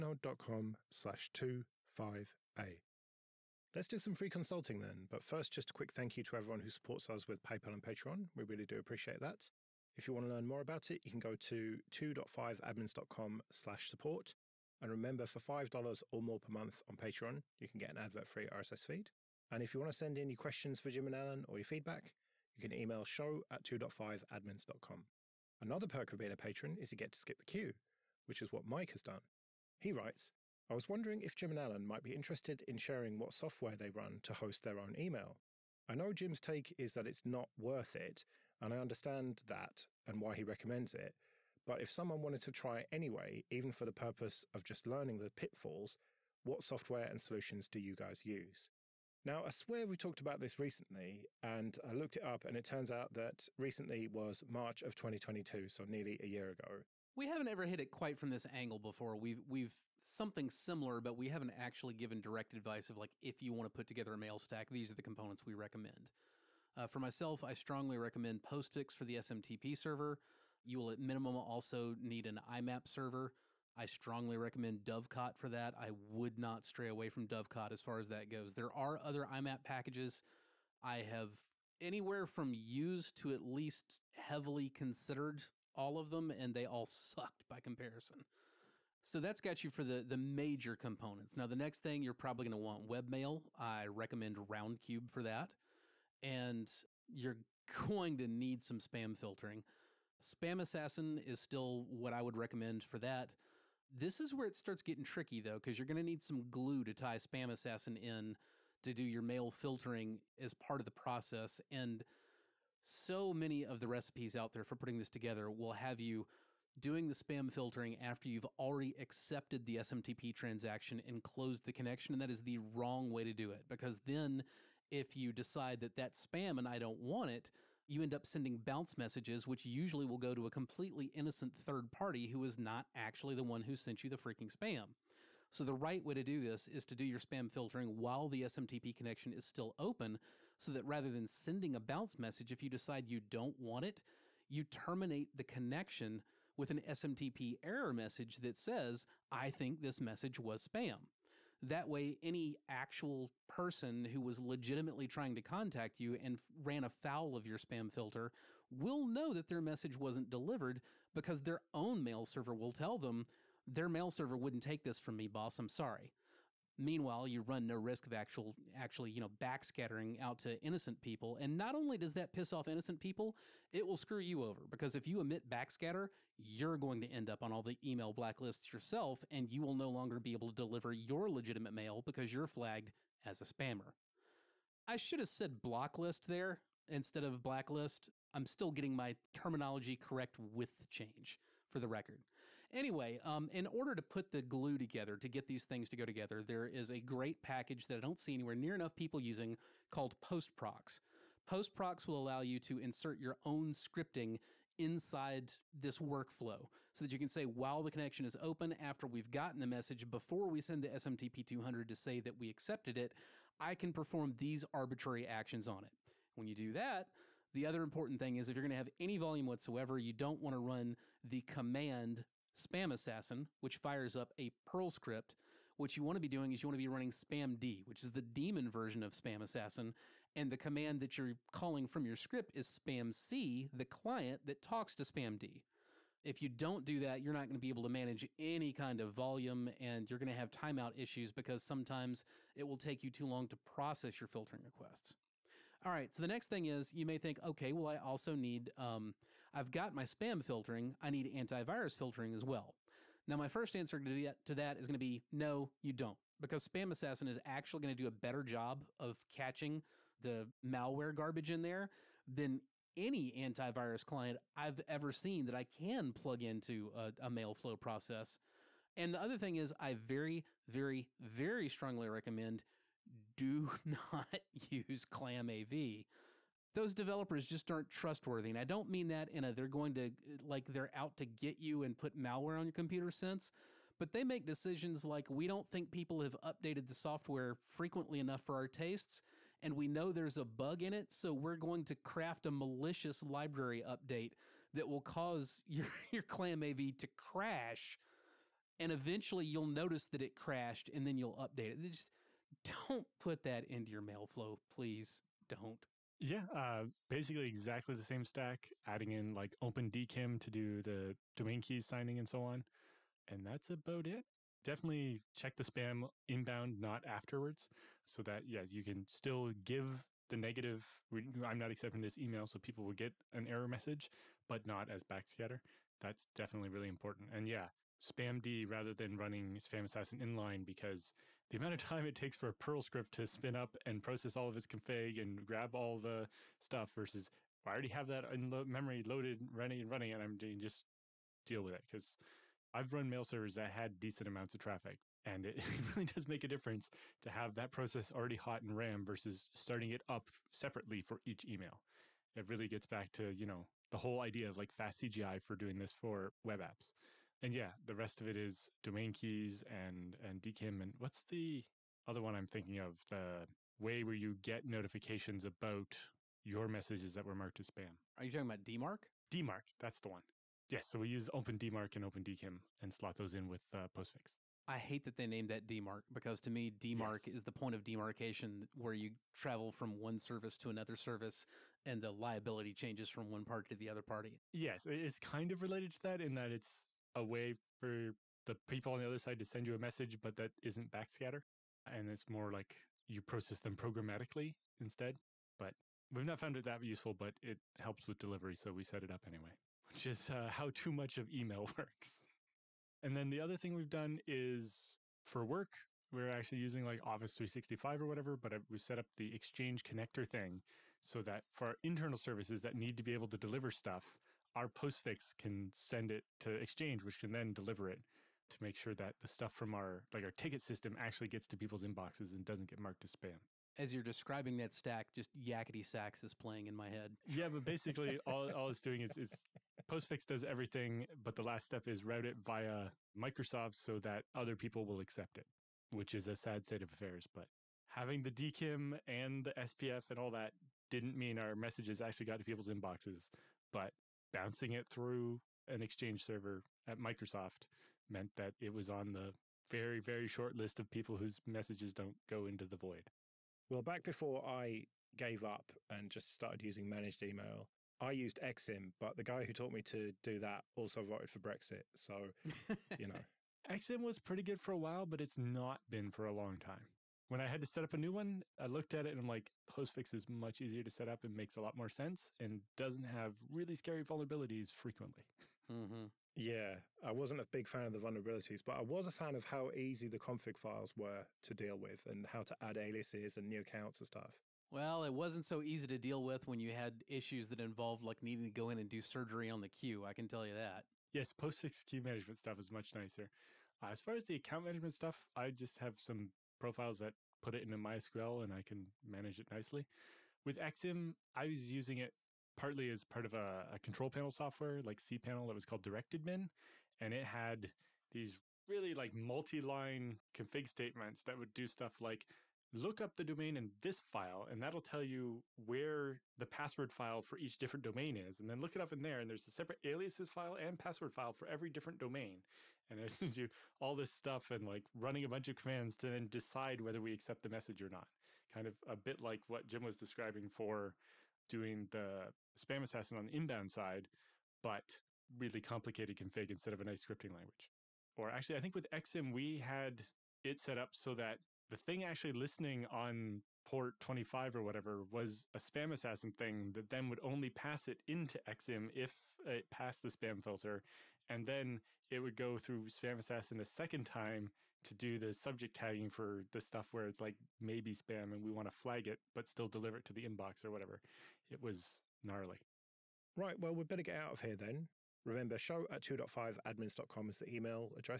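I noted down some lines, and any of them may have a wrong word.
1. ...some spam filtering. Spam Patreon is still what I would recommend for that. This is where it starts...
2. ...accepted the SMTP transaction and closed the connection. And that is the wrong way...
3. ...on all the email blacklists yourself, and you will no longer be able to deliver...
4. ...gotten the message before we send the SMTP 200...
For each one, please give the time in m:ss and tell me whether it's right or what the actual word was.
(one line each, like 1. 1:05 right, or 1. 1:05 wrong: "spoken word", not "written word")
1. 1:38 wrong: "Assassin", not "Patreon"
2. 1:58 right
3. 2:57 right
4. 3:29 right.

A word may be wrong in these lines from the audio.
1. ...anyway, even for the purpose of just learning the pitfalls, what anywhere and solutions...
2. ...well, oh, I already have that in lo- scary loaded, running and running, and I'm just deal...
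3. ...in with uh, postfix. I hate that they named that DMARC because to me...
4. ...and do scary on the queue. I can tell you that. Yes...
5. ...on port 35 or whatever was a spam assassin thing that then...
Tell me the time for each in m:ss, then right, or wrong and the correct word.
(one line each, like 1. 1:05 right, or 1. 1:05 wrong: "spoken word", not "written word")
1. 0:42 wrong: "software", not "anywhere"
2. 5:37 wrong: "memory", not "scary"
3. 6:13 right
4. 8:08 wrong: "surgery", not "scary"
5. 9:02 wrong: "25", not "35".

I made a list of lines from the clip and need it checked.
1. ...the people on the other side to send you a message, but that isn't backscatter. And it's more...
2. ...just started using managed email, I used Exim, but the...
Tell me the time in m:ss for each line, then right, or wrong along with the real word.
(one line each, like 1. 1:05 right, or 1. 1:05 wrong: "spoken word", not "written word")
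1. 6:28 right
2. 7:36 right.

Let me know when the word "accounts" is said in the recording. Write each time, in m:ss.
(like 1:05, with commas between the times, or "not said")
8:03, 8:14.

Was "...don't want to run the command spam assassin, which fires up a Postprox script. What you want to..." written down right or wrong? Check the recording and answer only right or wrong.
wrong.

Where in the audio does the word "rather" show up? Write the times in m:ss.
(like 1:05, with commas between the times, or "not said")
2:20, 5:28.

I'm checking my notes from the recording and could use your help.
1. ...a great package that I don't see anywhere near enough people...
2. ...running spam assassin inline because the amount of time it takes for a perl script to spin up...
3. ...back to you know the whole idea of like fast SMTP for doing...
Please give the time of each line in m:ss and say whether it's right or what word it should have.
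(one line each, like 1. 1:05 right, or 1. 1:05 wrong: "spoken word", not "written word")
1. 3:16 right
2. 5:29 right
3. 5:52 wrong: "CGI", not "SMTP".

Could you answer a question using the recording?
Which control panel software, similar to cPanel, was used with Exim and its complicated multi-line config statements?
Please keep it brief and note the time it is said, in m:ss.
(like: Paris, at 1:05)
DirectAdmin, at 8:25.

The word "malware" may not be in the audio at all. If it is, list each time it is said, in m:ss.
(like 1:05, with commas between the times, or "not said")
4:20, 4:42.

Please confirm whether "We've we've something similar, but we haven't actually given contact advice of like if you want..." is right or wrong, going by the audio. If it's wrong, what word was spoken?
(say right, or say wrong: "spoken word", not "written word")
wrong: "direct", not "contact".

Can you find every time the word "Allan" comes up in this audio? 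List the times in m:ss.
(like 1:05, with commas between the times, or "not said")
0:21, 0:31.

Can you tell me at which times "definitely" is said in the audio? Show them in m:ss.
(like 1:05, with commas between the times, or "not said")
5:14, 5:26.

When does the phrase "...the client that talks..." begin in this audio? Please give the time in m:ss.
3:53.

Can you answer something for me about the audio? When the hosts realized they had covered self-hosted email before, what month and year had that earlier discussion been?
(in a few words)
March 2022.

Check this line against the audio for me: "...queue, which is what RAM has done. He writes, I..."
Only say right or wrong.
wrong.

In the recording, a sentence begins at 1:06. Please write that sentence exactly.
Uh, for myself, I strongly recommend Postfix for the SMTP server.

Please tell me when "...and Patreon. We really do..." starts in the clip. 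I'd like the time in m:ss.
0:07.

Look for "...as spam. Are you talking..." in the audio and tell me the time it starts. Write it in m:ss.
6:07.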